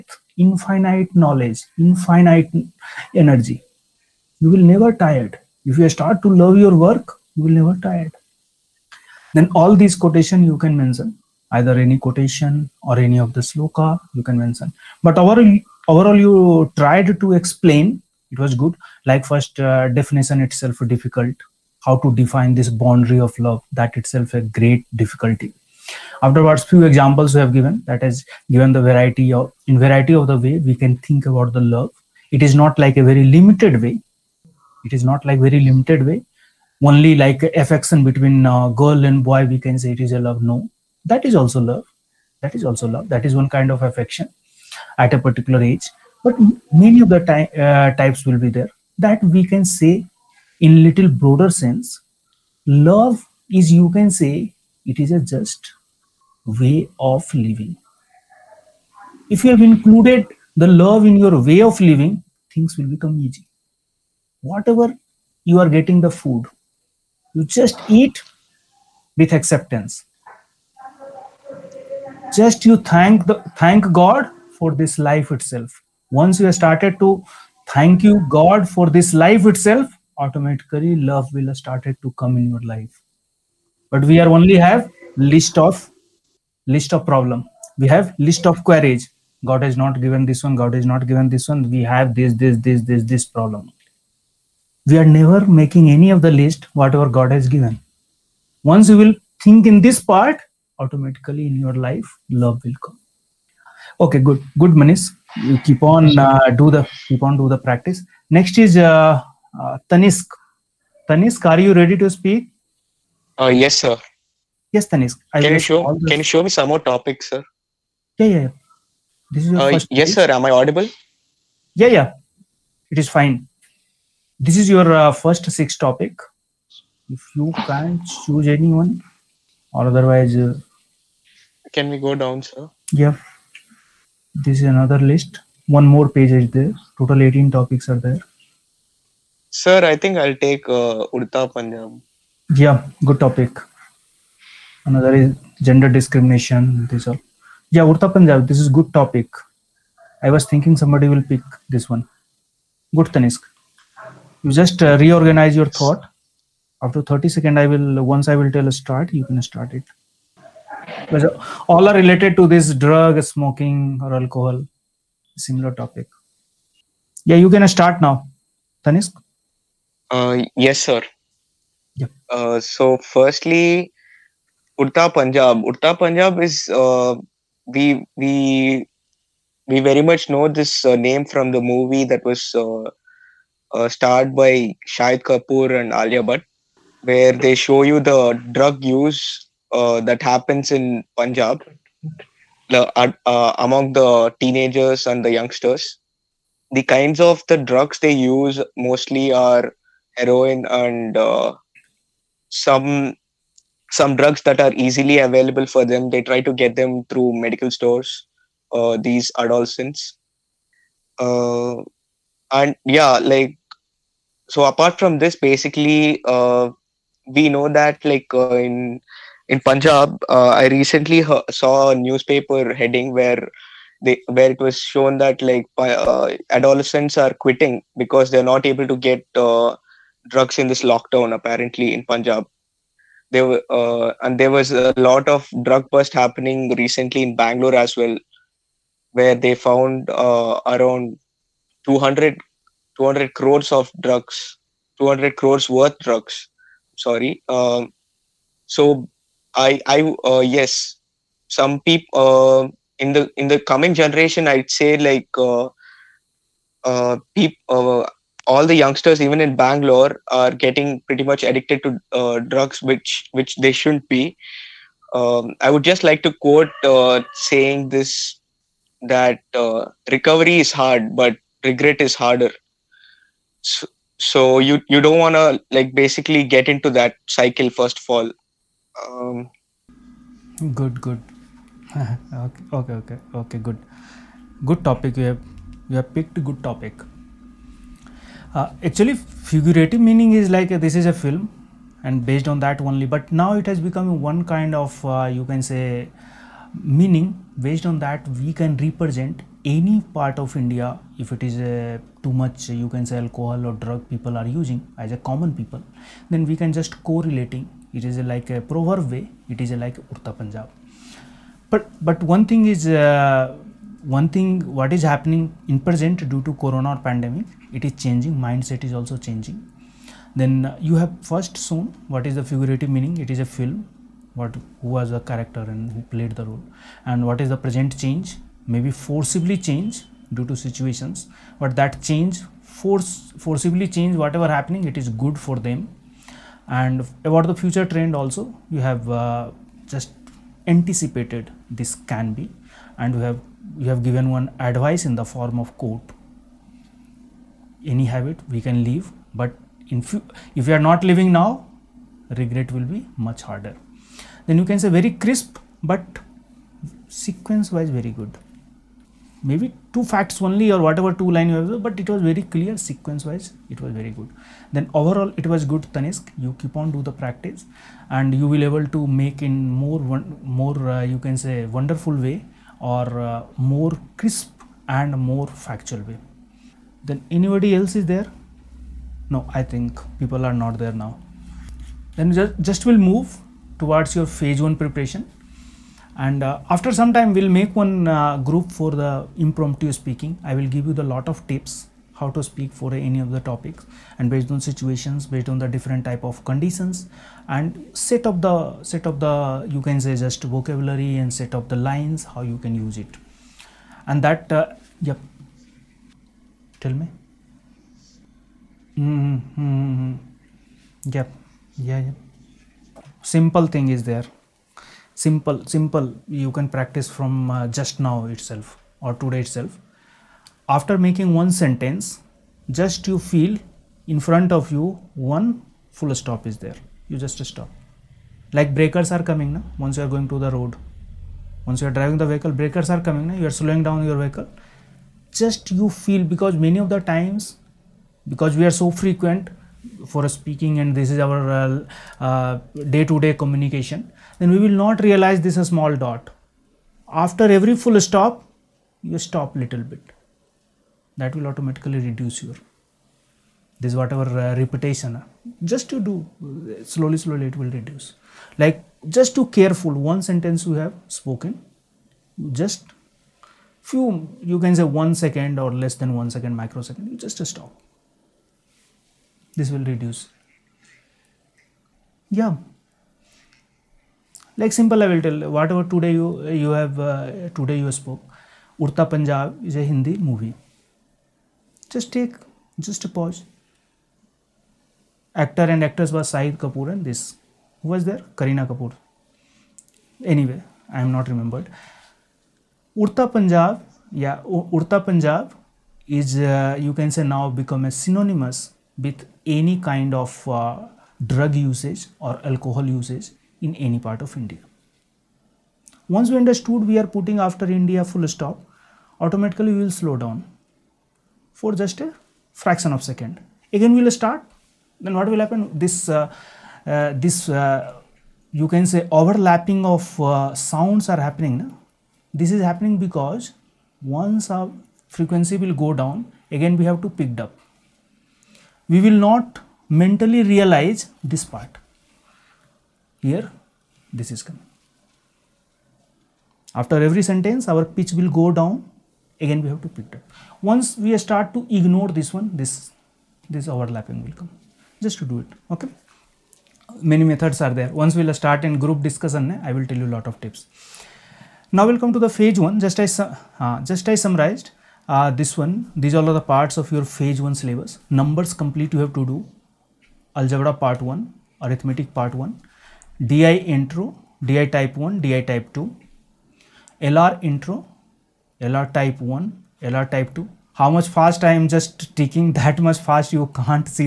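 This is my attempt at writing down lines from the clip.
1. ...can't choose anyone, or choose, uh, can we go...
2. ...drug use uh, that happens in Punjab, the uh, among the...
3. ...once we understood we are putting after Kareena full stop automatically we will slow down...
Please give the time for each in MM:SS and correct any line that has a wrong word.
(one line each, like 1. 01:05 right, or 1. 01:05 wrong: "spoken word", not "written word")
1. 02:07 wrong: "otherwise", not "choose"
2. 03:08 right
3. 08:26 wrong: "India", not "Kareena".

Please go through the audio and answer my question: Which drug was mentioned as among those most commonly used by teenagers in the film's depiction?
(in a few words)
Heroin.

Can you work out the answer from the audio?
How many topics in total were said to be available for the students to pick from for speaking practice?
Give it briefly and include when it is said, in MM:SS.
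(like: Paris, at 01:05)
18, at 02:17.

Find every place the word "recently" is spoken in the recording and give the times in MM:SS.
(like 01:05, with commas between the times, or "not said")
03:40, 03:56.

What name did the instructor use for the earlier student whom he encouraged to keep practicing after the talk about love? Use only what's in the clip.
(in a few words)
Manish.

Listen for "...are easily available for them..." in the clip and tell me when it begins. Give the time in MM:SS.
03:24.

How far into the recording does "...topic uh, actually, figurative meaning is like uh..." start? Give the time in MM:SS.
04:46.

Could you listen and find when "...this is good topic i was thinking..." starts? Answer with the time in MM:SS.
02:28.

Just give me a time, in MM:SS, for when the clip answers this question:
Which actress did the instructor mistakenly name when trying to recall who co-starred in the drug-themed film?
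08:08.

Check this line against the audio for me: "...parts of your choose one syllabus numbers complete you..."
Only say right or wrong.
wrong.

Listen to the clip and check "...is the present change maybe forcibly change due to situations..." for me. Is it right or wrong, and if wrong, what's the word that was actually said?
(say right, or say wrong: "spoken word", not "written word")
right.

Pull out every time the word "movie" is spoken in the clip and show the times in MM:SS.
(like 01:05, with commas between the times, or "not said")
03:01, 08:00.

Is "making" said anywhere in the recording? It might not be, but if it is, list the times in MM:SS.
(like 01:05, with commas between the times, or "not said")
01:35, 07:00.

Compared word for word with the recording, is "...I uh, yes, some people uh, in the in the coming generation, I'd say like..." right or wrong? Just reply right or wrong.
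right.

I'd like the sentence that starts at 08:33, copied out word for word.
Again we will start, then what will happen?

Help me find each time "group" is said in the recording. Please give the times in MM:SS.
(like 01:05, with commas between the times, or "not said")
06:28, 09:08.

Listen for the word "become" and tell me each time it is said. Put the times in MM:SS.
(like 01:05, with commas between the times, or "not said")
01:02, 04:53, 08:17.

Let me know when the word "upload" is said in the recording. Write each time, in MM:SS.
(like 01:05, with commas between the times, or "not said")
not said.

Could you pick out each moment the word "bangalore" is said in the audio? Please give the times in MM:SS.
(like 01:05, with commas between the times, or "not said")
03:57, 04:19.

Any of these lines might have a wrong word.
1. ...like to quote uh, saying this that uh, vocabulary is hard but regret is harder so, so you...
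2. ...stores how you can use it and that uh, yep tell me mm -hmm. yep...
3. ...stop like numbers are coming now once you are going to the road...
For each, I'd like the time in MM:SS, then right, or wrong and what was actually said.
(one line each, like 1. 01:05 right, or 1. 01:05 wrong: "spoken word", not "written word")
1. 04:26 wrong: "recovery", not "vocabulary"
2. 06:41 wrong: "lines", not "stores"
3. 07:07 wrong: "breakers", not "numbers".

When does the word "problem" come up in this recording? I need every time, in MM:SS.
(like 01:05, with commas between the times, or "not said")
01:27, 01:33.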